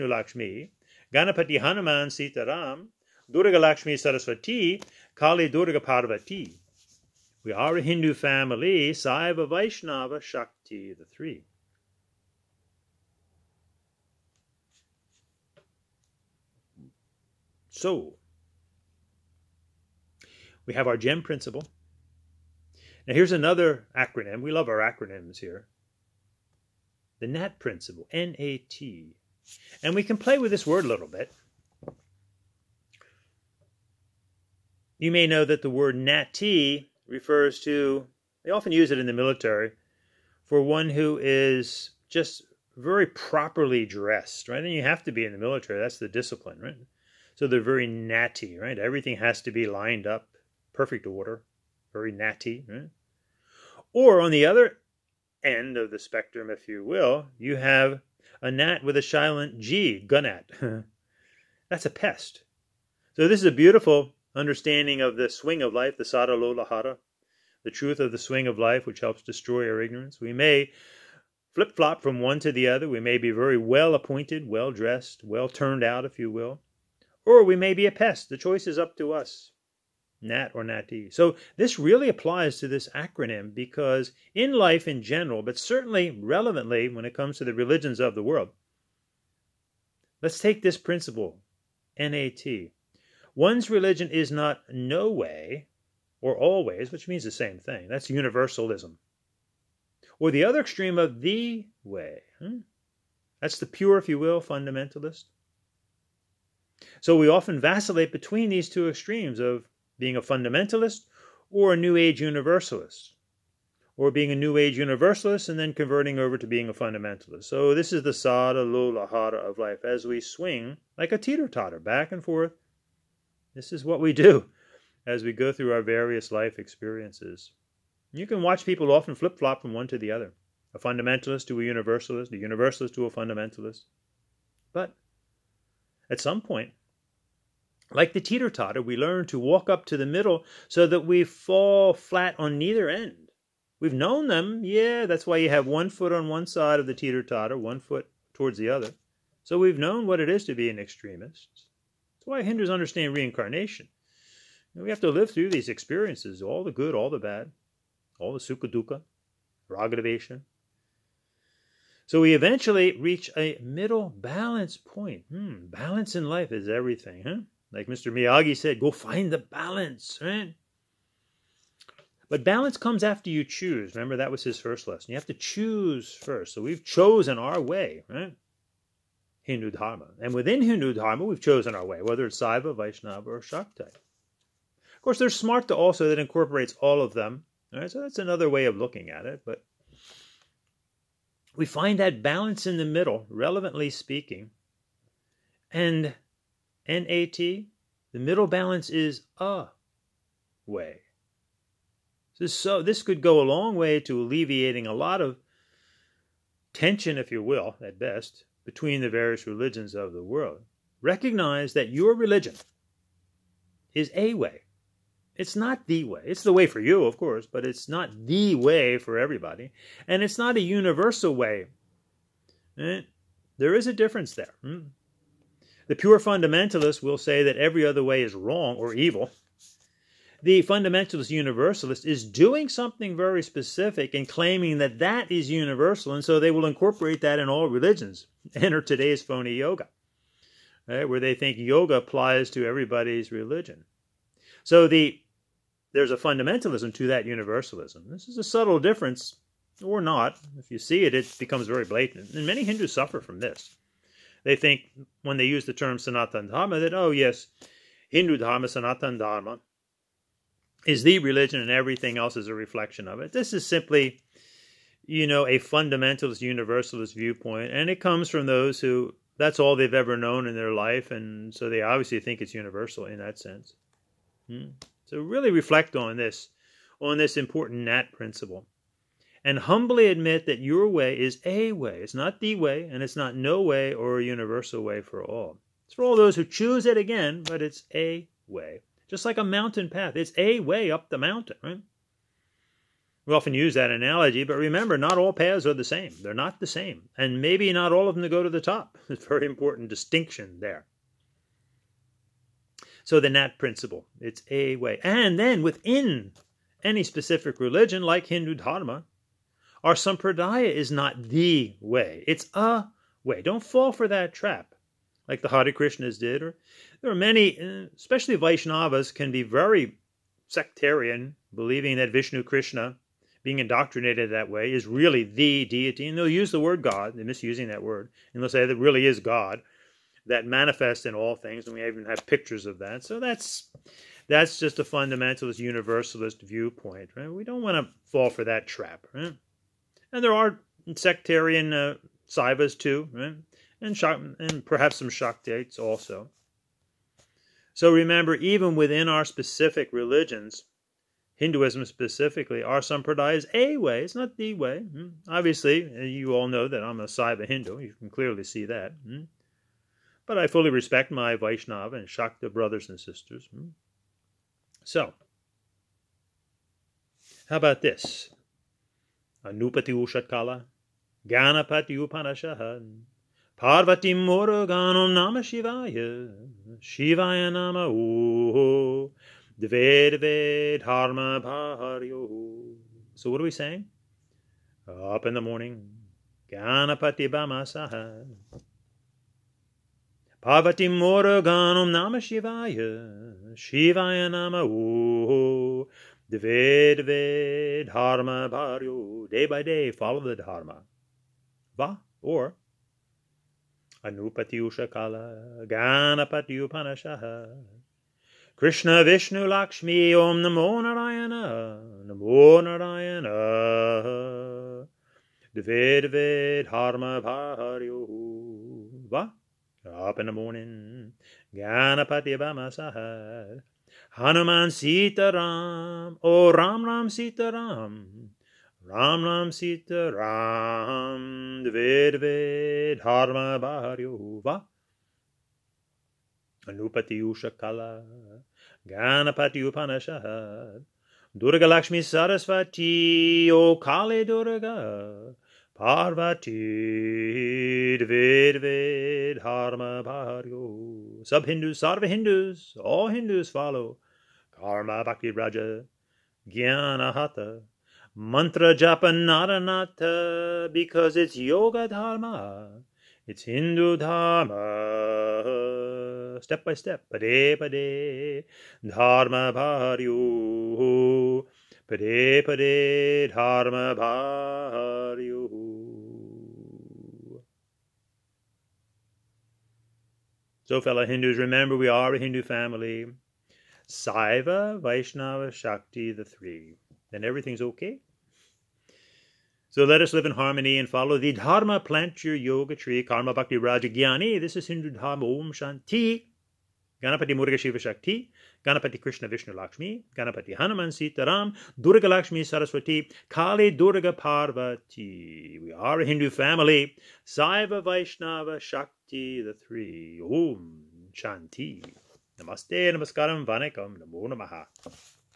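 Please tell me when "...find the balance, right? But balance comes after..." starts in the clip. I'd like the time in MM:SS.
02:48.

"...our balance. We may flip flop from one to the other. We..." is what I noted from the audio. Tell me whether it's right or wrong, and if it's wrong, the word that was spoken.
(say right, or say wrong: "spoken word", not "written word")
wrong: "ignorance", not "balance".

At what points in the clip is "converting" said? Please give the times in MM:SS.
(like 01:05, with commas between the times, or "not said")
01:55.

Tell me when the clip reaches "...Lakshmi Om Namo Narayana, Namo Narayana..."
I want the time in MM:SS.
06:49.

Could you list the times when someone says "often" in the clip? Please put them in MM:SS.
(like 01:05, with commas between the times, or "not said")
00:38, 01:47, 02:08, 04:53.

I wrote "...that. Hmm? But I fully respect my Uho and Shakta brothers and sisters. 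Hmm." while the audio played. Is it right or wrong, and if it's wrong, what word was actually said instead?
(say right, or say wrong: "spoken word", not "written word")
wrong: "Vaishnava", not "Uho".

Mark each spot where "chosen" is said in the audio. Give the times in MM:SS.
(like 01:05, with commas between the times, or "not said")
02:56, 03:01.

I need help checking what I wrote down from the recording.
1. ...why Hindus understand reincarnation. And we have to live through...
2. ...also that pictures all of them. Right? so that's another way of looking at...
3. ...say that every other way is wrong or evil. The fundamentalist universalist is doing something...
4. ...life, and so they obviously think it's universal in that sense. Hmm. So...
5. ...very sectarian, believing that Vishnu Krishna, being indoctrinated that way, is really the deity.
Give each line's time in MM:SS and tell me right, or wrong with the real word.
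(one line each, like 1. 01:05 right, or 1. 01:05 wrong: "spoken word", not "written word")
1. 02:32 right
2. 03:05 wrong: "incorporates", not "pictures"
3. 03:47 right
4. 04:30 right
5. 05:19 right.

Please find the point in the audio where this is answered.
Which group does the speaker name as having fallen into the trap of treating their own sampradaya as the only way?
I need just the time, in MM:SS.
05:15.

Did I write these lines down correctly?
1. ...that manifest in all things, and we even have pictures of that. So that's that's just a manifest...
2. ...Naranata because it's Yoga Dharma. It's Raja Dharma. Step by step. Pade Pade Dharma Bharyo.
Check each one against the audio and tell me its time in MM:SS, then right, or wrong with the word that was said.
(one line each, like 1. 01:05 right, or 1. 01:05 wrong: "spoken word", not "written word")
1. 05:30 wrong: "fundamentalist", not "manifest"
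2. 07:39 wrong: "Hindu", not "Raja".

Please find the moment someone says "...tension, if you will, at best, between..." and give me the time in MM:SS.
03:26.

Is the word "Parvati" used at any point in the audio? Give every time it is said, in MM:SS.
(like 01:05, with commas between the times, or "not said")
00:05, 06:13, 06:30, 07:25, 08:24.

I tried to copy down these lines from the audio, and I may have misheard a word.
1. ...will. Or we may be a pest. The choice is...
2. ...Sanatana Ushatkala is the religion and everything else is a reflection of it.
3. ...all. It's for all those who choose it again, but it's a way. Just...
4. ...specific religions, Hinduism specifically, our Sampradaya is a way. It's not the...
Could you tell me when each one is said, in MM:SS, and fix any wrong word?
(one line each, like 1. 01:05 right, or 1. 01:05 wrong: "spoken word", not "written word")
1. 01:16 right
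2. 04:18 wrong: "Dharma", not "Ushatkala"
3. 04:45 right
4. 05:49 right.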